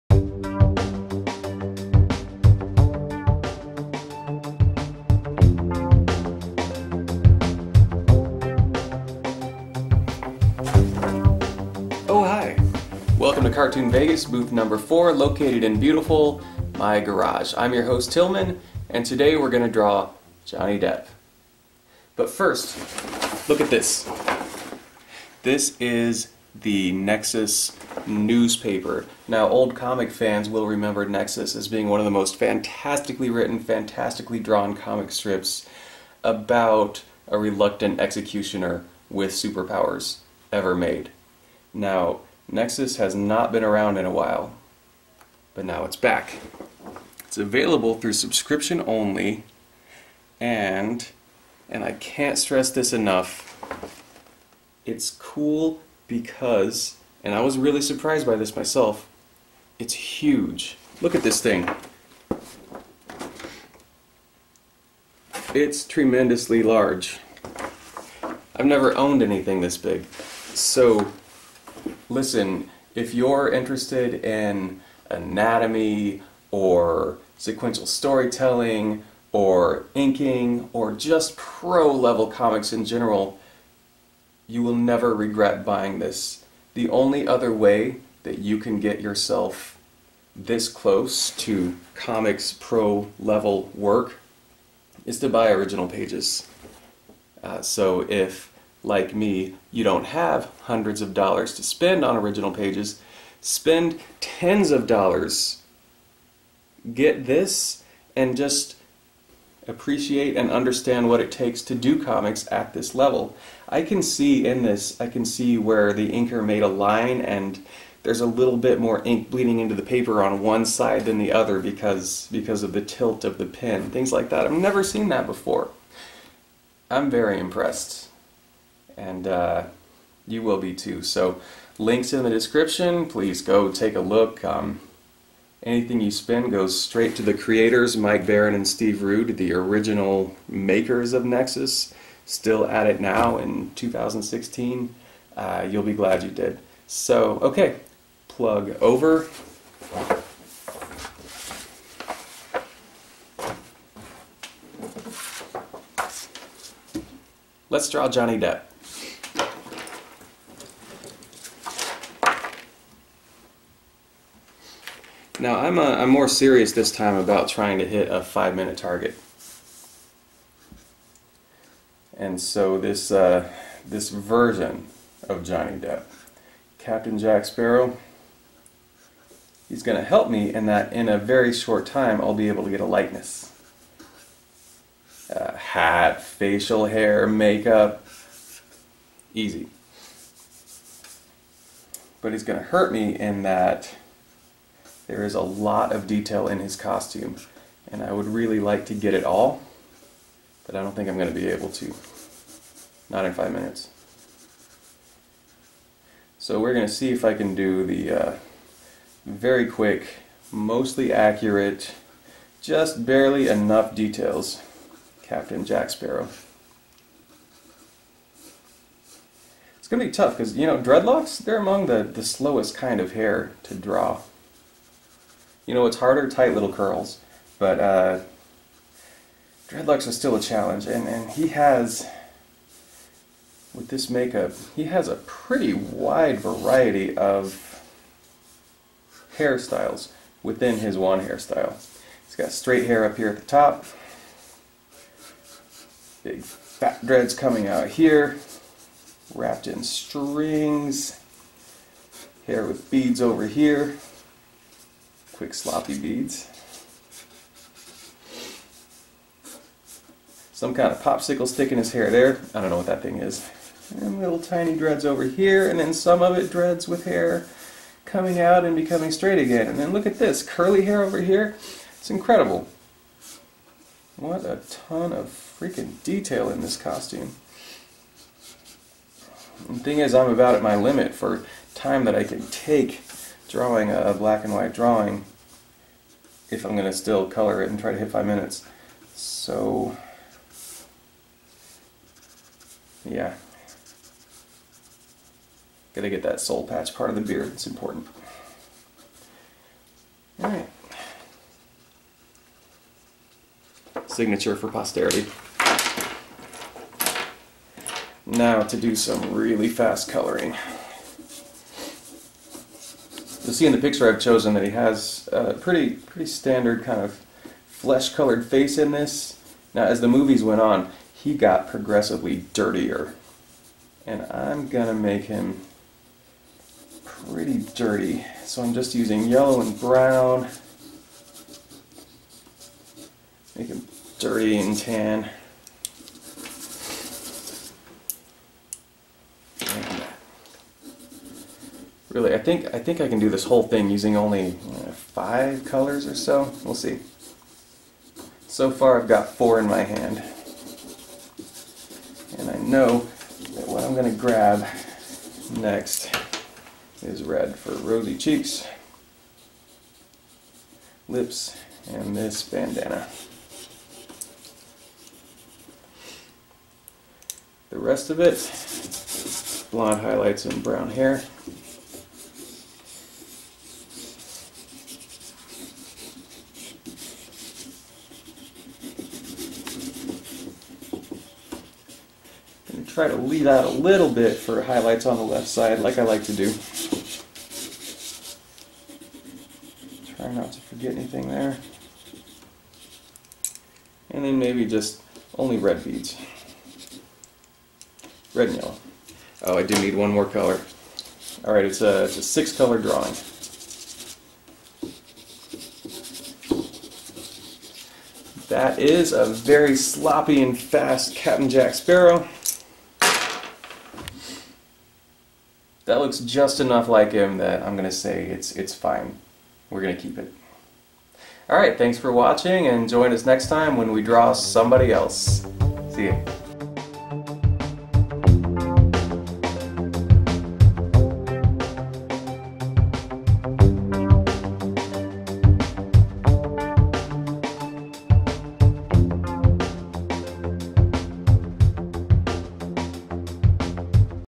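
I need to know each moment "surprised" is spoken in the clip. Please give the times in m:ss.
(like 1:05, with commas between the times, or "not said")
0:57.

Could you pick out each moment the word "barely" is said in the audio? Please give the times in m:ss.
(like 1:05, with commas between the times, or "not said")
3:33.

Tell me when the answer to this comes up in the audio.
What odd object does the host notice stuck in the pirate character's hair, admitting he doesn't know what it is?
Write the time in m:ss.
4:21.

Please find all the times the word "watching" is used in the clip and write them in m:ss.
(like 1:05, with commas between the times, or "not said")
7:02.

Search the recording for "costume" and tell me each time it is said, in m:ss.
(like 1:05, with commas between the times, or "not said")
3:16, 4:36.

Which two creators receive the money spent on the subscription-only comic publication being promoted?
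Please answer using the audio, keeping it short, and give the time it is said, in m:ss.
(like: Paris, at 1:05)
Mike Baron and Steve Rude, at 2:17.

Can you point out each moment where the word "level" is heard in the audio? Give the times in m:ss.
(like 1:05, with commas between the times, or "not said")
1:21, 1:33, 1:52.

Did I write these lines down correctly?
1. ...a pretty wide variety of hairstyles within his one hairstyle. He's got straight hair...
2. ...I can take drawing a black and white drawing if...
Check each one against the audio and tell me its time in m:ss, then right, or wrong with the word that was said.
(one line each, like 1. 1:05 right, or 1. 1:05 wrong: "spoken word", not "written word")
1. 3:55 right
2. 4:42 right.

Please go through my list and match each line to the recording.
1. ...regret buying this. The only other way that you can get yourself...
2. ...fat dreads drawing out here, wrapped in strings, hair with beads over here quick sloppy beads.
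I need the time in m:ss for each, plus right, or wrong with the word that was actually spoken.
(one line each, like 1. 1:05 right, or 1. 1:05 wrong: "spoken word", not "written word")
1. 1:25 right
2. 4:06 wrong: "coming", not "drawing".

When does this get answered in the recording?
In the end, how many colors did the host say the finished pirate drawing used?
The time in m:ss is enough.
6:42.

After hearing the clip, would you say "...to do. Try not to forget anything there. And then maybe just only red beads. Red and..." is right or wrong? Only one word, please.
right.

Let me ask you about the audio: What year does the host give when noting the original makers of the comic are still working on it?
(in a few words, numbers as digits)
2016.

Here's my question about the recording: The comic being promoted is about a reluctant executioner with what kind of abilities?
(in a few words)
superpowers.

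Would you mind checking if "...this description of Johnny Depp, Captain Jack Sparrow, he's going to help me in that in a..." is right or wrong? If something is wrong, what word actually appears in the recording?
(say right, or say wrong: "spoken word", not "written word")
wrong: "version", not "description".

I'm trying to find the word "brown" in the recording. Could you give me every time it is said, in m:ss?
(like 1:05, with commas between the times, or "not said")
5:29, 6:10.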